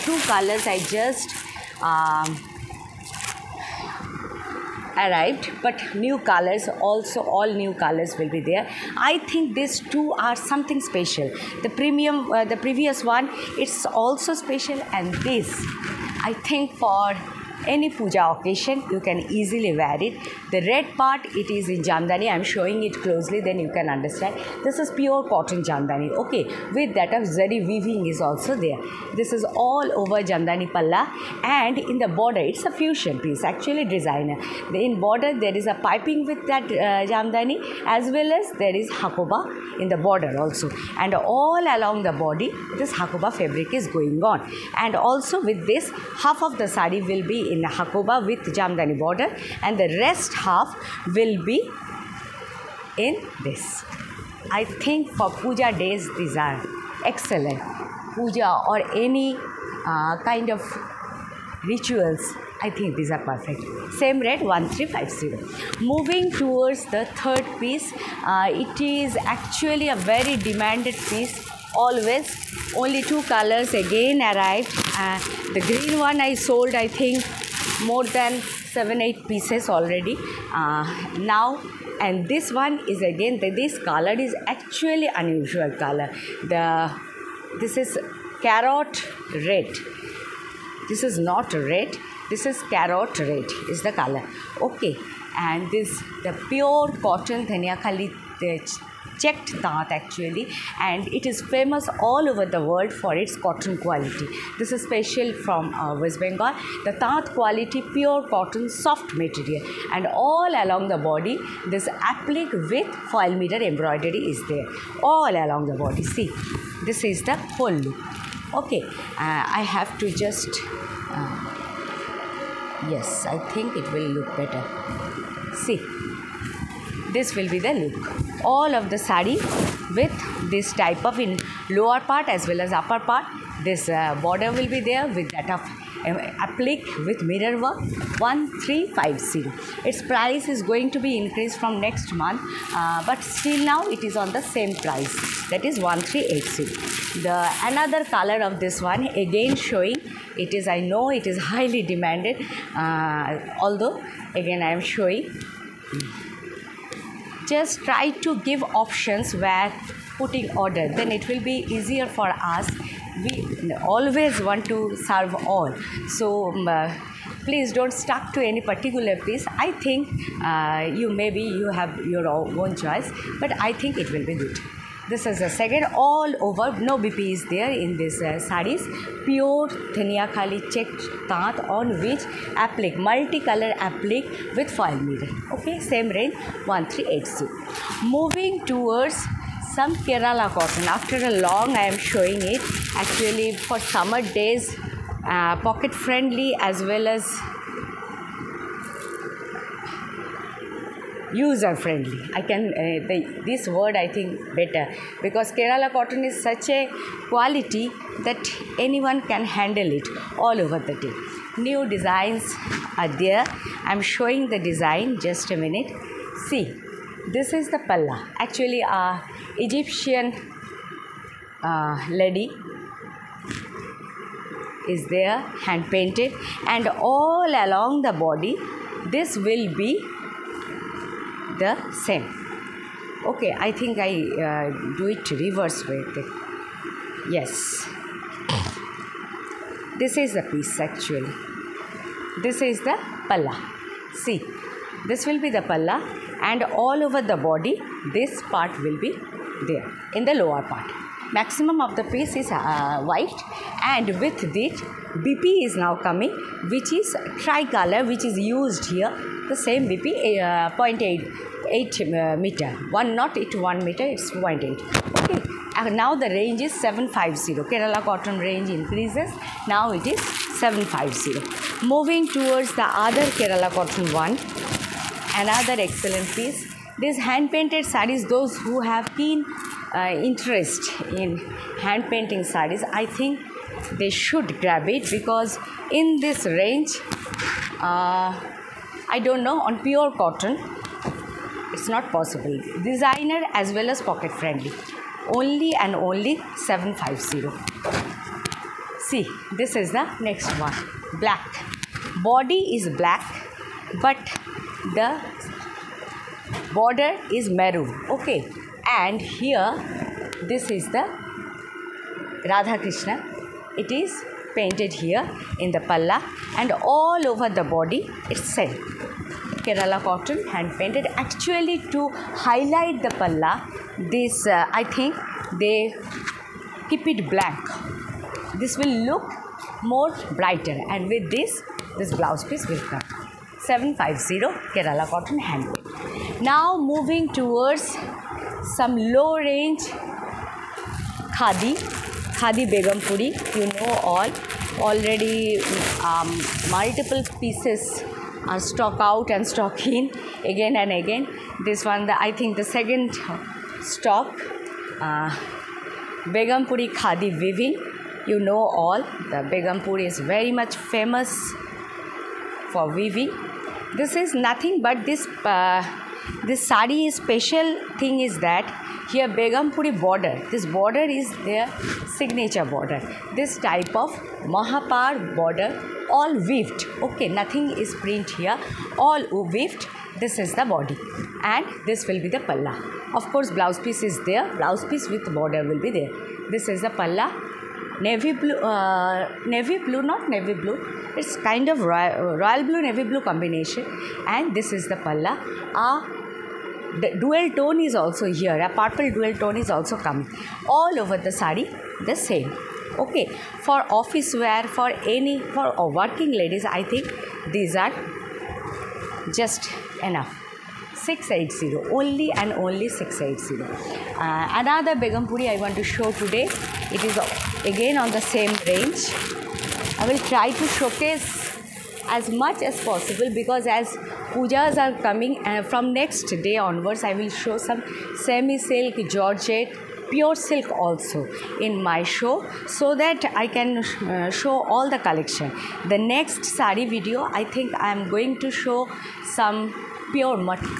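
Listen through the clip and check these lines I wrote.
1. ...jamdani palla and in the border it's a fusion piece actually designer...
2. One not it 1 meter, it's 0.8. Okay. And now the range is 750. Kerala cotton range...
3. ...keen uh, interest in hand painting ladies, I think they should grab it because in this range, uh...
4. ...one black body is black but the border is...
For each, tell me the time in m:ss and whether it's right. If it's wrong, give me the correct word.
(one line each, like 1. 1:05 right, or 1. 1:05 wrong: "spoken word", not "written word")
1. 0:30 right
2. 4:22 right
3. 4:39 wrong: "sarees", not "ladies"
4. 5:00 right.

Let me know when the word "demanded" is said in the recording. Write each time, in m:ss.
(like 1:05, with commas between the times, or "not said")
1:10, 2:31.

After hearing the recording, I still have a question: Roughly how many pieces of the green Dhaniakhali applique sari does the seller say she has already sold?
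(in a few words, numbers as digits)
7 or 8.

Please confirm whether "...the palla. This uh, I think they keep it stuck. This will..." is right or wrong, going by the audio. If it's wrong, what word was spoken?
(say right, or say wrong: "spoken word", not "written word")
wrong: "black", not "stuck".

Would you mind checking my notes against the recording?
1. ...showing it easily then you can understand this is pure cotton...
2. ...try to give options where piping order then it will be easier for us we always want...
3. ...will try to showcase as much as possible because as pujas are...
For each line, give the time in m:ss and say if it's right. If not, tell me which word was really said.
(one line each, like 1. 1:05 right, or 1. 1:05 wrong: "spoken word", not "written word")
1. 0:22 wrong: "closely", not "easily"
2. 2:37 wrong: "putting", not "piping"
3. 7:00 right.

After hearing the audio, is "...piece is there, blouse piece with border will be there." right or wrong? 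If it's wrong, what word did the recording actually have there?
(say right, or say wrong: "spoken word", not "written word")
right.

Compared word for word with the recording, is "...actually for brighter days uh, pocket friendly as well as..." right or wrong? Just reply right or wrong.
wrong.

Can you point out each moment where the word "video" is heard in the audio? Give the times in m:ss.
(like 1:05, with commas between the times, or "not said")
7:16.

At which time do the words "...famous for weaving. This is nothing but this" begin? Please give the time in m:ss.
6:00.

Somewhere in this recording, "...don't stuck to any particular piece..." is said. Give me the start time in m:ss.
2:47.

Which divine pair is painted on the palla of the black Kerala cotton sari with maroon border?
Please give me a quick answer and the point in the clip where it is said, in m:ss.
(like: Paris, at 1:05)
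Radha Krishna, at 5:12.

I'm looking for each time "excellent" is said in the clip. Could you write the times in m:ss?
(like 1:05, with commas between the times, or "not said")
0:57, 4:35.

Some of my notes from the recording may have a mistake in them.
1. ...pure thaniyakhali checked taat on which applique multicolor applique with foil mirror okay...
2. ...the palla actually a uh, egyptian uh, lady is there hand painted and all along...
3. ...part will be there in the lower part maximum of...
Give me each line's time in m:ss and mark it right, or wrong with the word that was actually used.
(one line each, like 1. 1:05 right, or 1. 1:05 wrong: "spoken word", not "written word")
1. 2:59 right
2. 3:37 right
3. 4:08 right.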